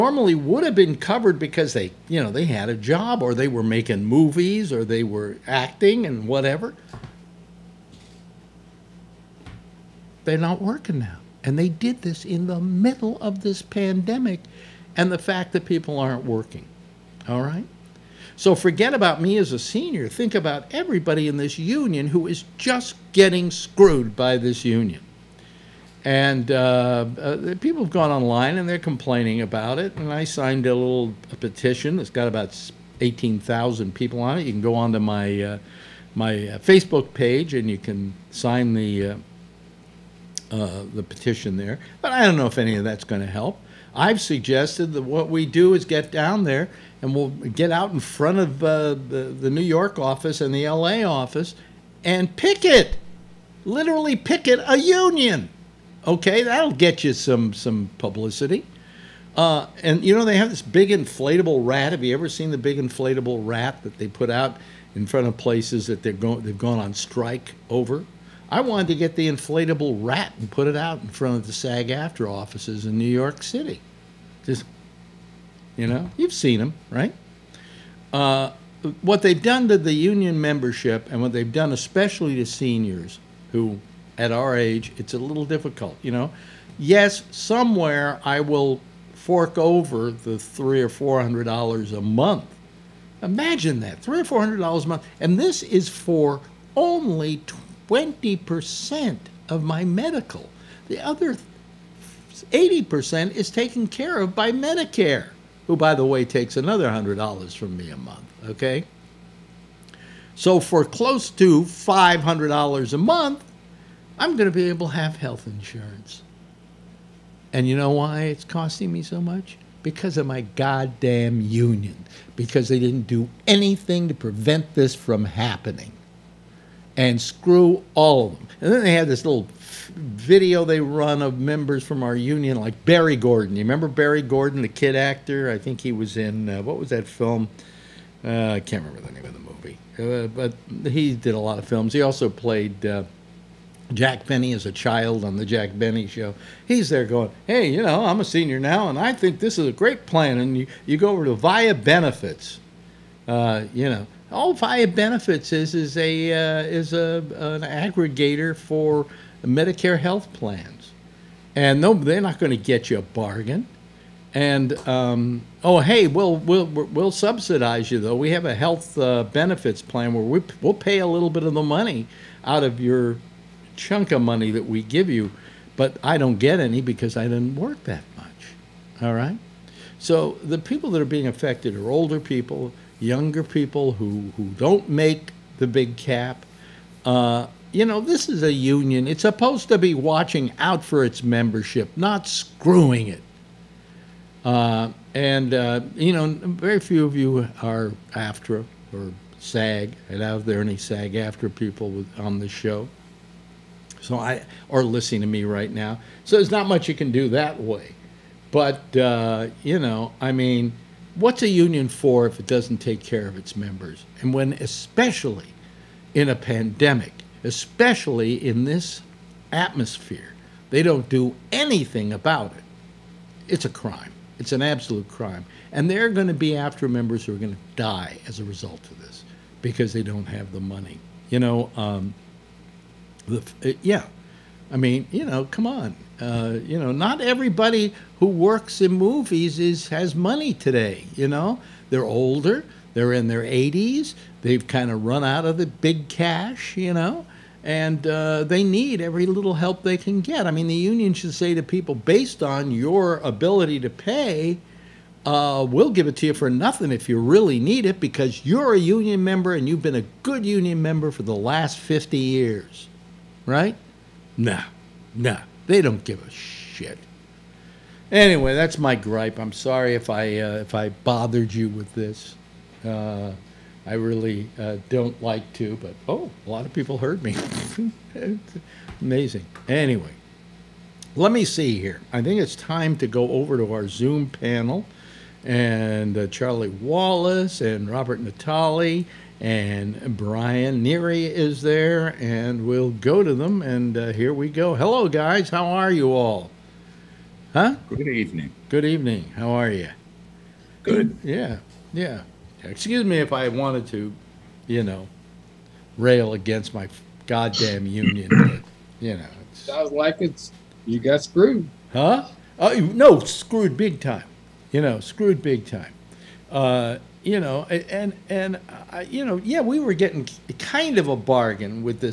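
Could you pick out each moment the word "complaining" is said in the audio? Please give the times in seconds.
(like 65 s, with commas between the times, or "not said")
28 s.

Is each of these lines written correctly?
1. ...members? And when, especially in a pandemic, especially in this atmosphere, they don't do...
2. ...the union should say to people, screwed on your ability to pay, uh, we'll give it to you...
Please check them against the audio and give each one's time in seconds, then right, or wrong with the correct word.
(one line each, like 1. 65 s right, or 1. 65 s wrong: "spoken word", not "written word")
1. 213 s right
2. 250 s wrong: "based", not "screwed".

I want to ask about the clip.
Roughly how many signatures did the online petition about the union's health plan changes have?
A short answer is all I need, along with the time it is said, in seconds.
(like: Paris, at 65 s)
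18,000, at 33 s.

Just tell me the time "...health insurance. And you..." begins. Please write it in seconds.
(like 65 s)
115 s.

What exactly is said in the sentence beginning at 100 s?
The other 80% is taken care of by Medicare, who, by the way, takes another $100 from me a month, okay?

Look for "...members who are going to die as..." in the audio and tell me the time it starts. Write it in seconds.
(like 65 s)
226 s.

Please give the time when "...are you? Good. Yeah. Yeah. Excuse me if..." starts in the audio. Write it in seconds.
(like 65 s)
299 s.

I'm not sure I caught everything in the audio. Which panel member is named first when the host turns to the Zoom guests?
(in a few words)
Charlie Wallace.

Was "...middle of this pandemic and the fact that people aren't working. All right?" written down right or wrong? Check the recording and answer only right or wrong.
right.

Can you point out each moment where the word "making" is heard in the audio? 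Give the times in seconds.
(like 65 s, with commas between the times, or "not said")
3 s.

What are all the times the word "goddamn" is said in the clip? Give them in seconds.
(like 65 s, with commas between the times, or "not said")
120 s, 307 s.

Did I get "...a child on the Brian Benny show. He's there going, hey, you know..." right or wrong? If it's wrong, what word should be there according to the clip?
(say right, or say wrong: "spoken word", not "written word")
wrong: "Jack", not "Brian".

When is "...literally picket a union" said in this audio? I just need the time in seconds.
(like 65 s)
53 s.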